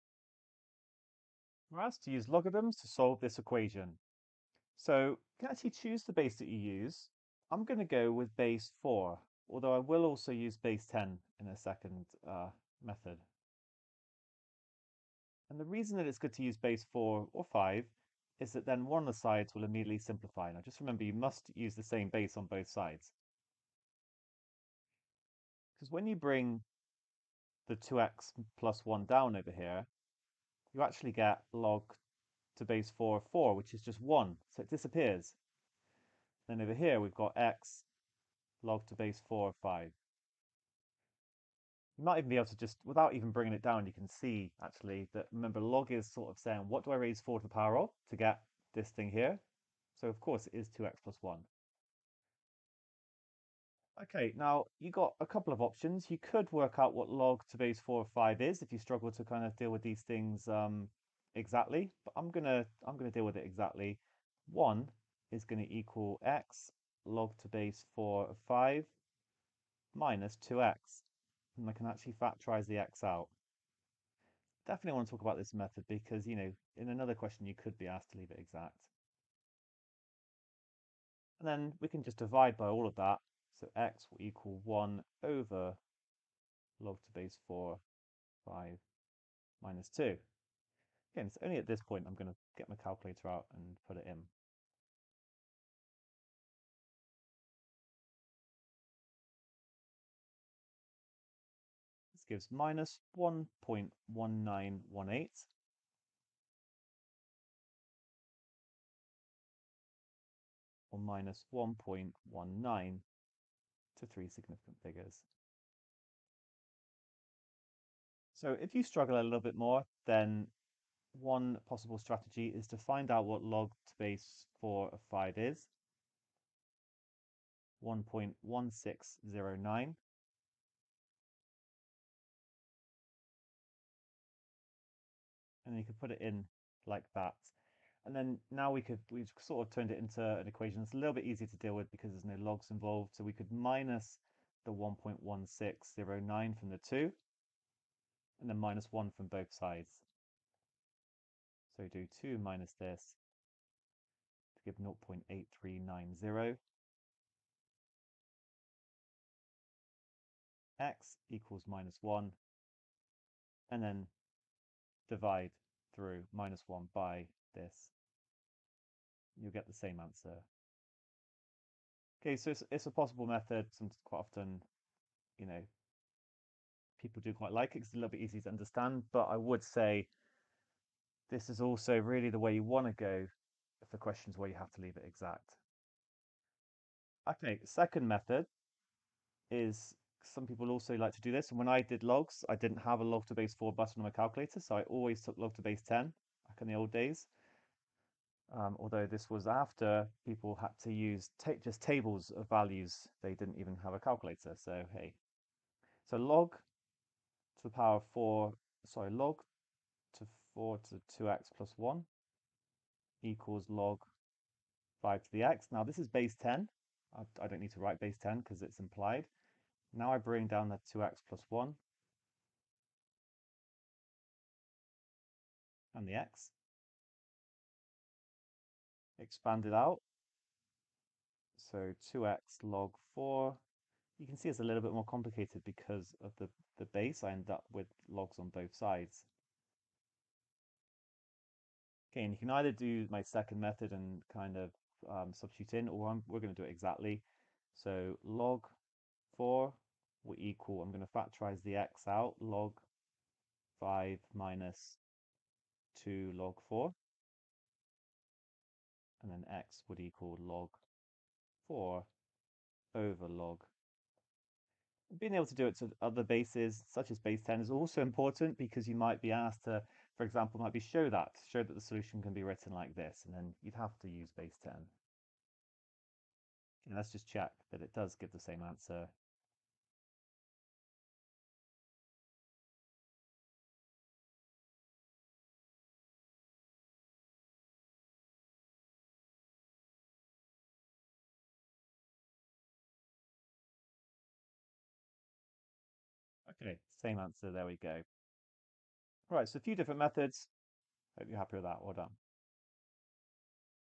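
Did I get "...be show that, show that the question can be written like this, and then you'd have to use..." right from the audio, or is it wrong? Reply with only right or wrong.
wrong.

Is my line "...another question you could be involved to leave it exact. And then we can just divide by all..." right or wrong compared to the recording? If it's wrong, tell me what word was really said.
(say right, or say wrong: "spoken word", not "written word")
wrong: "asked", not "involved".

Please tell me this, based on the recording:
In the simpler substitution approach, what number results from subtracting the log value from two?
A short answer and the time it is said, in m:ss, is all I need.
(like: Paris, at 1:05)
0.8390, at 2:34.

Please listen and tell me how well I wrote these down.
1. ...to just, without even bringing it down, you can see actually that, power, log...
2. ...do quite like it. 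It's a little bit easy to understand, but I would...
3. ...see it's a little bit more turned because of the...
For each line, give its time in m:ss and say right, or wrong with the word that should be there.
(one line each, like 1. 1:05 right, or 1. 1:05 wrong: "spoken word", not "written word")
1. 0:42 wrong: "remember", not "power"
2. 2:57 right
3. 3:54 wrong: "complicated", not "turned".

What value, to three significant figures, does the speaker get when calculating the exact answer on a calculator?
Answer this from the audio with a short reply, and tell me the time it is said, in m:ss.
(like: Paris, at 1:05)
-1.19, at 1:50.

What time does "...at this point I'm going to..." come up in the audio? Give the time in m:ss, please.
1:31.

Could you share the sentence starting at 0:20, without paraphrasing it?
Now just remember you must use the same base on both sides.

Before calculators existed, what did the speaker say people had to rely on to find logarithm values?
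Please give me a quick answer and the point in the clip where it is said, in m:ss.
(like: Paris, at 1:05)
tables of values, at 3:21.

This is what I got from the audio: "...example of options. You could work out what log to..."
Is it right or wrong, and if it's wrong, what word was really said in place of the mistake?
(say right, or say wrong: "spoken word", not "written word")
wrong: "couple", not "example".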